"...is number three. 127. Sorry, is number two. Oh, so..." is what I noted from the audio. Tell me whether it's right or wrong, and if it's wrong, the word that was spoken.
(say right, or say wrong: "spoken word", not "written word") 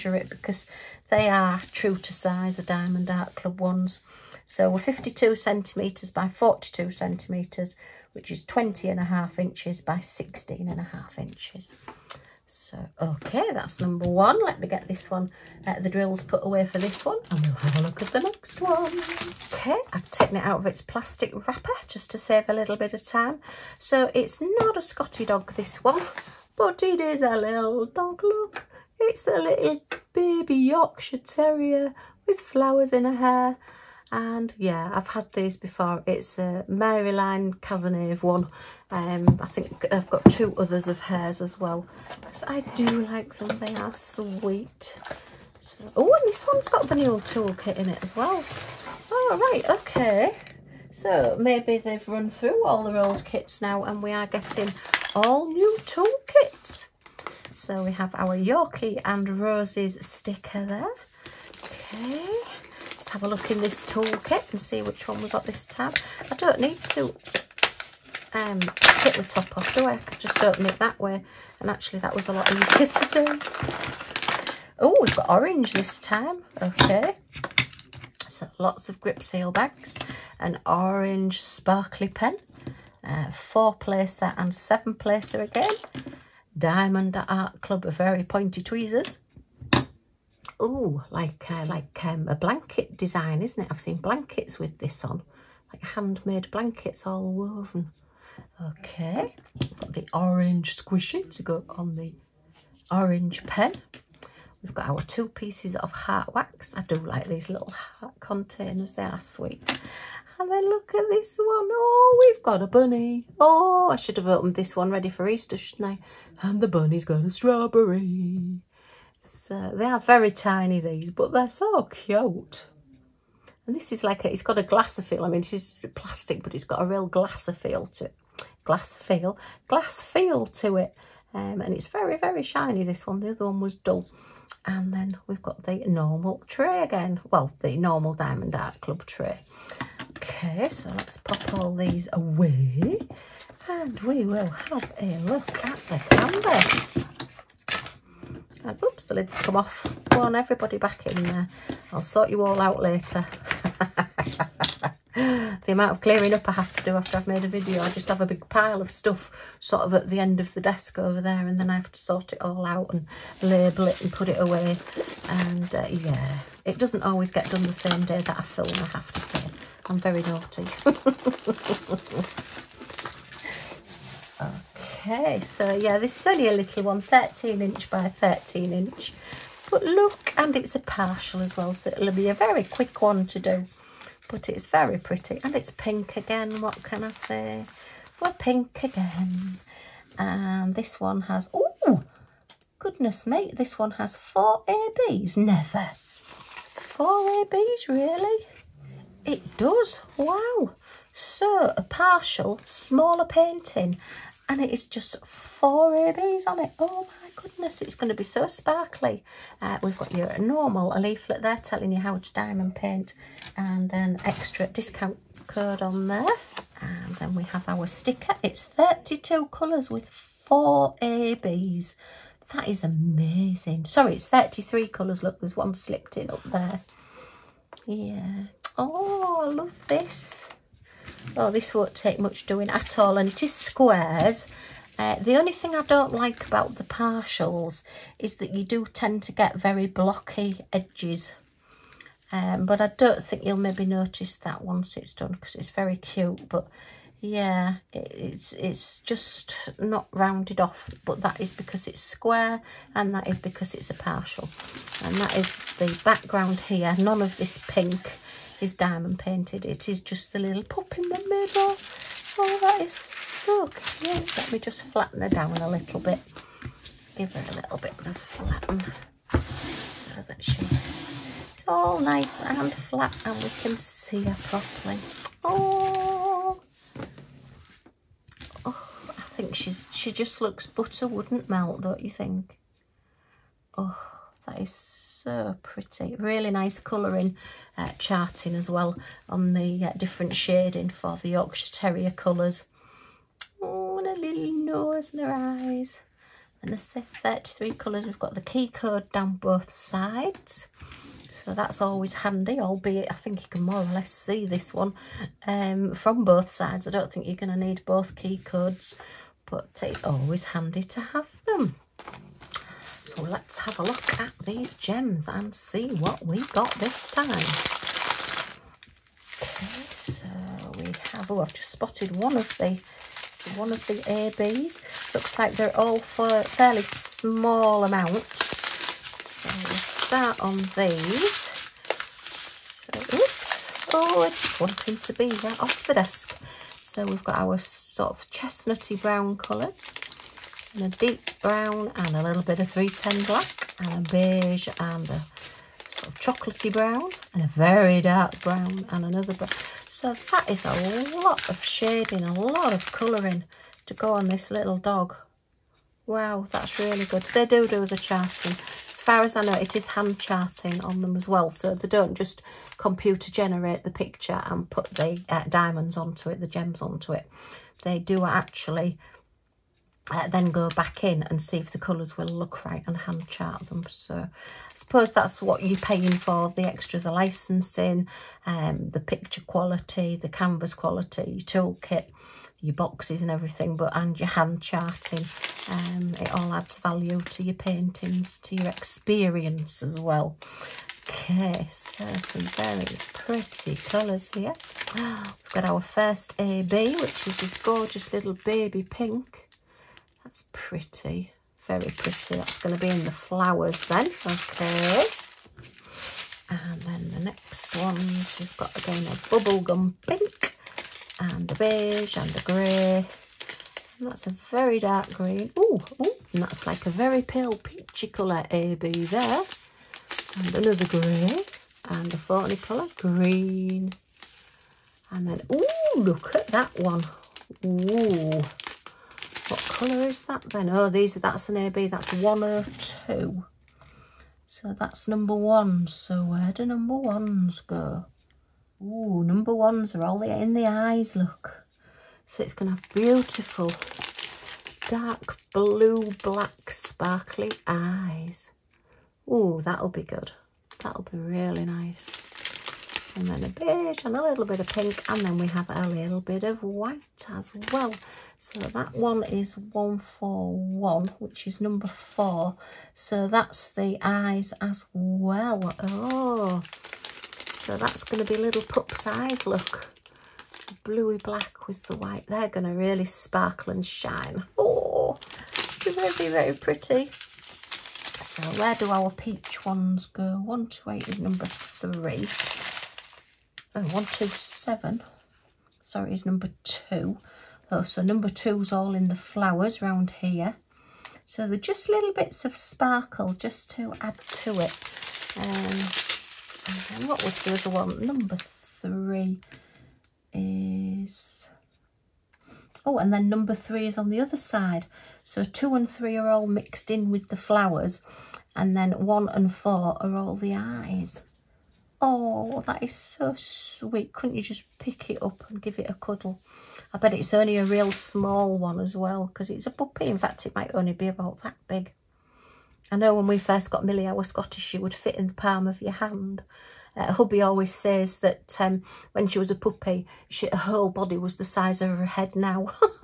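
right.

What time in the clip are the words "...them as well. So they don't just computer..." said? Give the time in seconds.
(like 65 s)
361 s.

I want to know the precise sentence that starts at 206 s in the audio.
Oh my goodness, it's going to be so sparkly.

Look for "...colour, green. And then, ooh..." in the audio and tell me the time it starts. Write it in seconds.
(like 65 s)
422 s.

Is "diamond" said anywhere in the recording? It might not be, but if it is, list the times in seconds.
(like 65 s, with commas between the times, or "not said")
2 s, 86 s, 138 s, 212 s, 258 s, 365 s.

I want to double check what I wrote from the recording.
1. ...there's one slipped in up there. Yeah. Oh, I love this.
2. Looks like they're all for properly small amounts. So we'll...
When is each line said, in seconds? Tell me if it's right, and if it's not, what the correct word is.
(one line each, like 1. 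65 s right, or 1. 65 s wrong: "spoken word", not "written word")
1. 225 s right
2. 325 s wrong: "fairly", not "properly".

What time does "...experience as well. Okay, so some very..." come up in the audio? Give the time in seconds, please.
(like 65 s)
388 s.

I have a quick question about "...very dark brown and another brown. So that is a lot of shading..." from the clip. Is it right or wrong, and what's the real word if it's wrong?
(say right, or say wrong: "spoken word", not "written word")
right.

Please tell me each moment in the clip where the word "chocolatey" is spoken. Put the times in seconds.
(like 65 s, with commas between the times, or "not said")
346 s.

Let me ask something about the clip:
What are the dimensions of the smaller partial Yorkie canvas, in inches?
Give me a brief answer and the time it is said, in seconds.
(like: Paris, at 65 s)
13 by 13 inches, at 177 s.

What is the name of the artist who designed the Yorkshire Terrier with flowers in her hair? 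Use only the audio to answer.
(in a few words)
Maryline Cazenave.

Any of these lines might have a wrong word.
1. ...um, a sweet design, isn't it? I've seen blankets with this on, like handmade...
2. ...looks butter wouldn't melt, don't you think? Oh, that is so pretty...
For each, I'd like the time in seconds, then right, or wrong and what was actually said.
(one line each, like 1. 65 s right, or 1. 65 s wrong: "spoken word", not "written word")
1. 92 s wrong: "blanket", not "sweet"
2. 280 s right.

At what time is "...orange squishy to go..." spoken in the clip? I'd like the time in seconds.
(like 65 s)
100 s.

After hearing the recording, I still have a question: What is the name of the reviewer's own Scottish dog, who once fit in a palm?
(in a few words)
Millie.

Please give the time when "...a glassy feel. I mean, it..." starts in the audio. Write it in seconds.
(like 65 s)
124 s.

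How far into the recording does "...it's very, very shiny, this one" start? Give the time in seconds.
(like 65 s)
131 s.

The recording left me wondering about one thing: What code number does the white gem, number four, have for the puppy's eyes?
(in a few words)
141.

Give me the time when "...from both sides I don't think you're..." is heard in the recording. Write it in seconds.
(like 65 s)
305 s.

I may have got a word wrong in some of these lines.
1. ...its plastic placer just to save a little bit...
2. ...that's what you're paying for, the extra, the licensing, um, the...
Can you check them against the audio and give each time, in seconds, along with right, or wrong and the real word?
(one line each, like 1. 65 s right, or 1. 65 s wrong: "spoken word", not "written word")
1. 20 s wrong: "wrapper", not "placer"
2. 375 s right.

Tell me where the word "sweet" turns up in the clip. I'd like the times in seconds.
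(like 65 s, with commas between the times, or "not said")
43 s, 109 s, 513 s.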